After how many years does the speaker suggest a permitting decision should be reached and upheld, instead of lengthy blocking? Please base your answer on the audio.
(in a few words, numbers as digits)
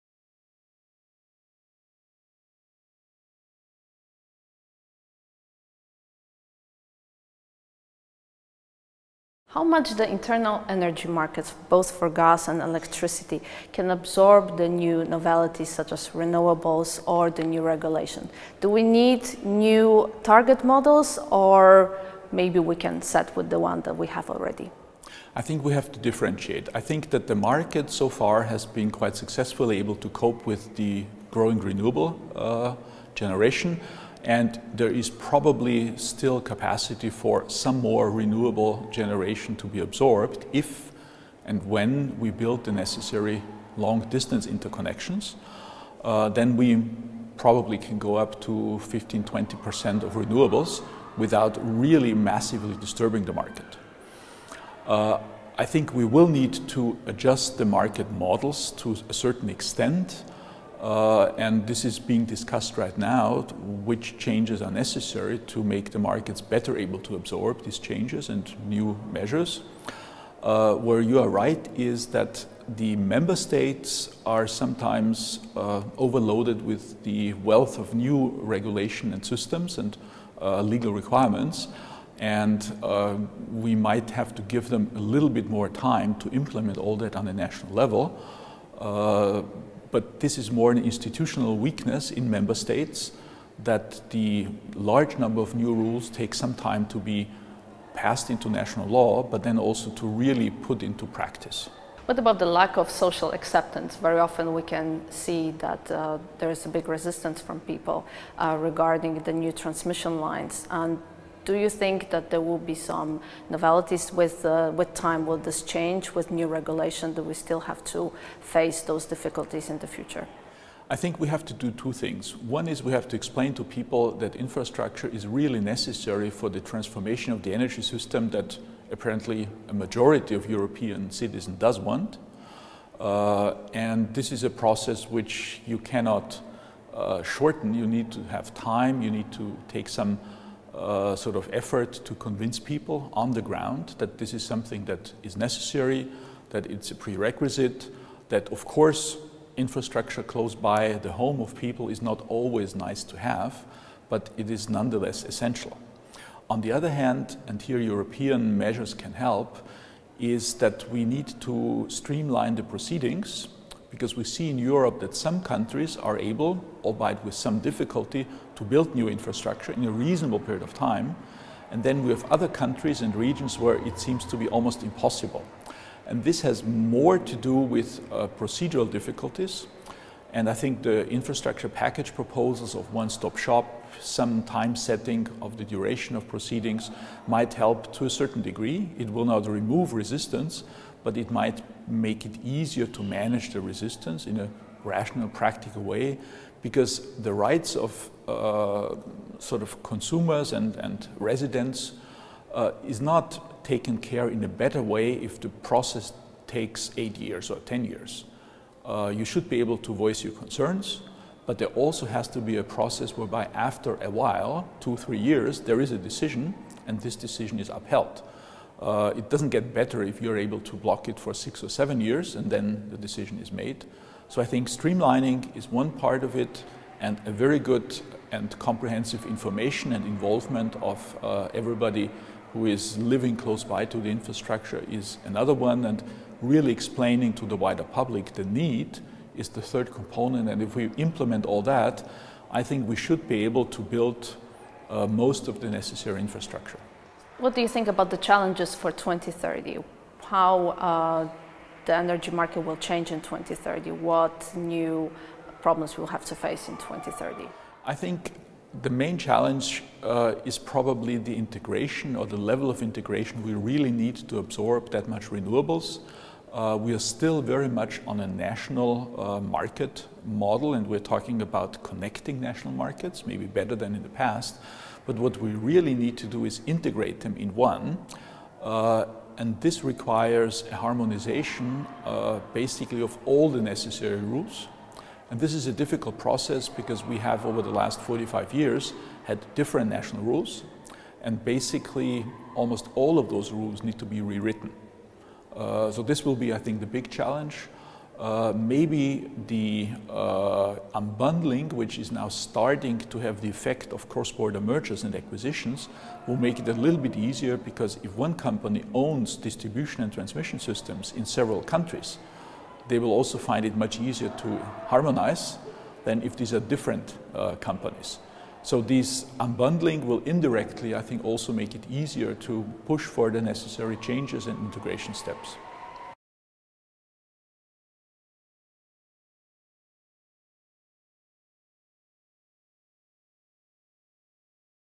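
2-3 years.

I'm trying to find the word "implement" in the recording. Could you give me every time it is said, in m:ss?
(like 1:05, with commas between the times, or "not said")
1:26, 4:00.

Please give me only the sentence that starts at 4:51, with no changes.
And basically, almost all of those rules need to be rewritten.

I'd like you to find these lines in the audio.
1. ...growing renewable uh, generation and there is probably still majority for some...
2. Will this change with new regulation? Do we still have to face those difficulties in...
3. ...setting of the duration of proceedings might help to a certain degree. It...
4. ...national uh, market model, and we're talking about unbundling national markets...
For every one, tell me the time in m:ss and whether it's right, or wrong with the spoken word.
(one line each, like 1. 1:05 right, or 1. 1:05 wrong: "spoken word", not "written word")
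1. 0:31 wrong: "capacity", not "majority"
2. 1:55 right
3. 3:04 right
4. 4:28 wrong: "connecting", not "unbundling".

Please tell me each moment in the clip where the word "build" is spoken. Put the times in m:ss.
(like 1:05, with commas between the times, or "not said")
0:42, 2:48, 4:03.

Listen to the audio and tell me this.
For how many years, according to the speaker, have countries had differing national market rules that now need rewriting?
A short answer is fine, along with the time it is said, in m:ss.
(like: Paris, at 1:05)
45 years, at 4:48.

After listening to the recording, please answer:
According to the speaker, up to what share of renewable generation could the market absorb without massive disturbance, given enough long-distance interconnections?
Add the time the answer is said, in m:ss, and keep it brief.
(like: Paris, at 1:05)
15-20%, at 0:48.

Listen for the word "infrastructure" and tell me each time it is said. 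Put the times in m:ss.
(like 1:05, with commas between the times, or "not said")
2:04, 2:29, 2:49, 3:01, 3:54, 4:06.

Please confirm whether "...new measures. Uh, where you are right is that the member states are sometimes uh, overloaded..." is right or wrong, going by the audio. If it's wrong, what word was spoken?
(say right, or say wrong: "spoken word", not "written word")
right.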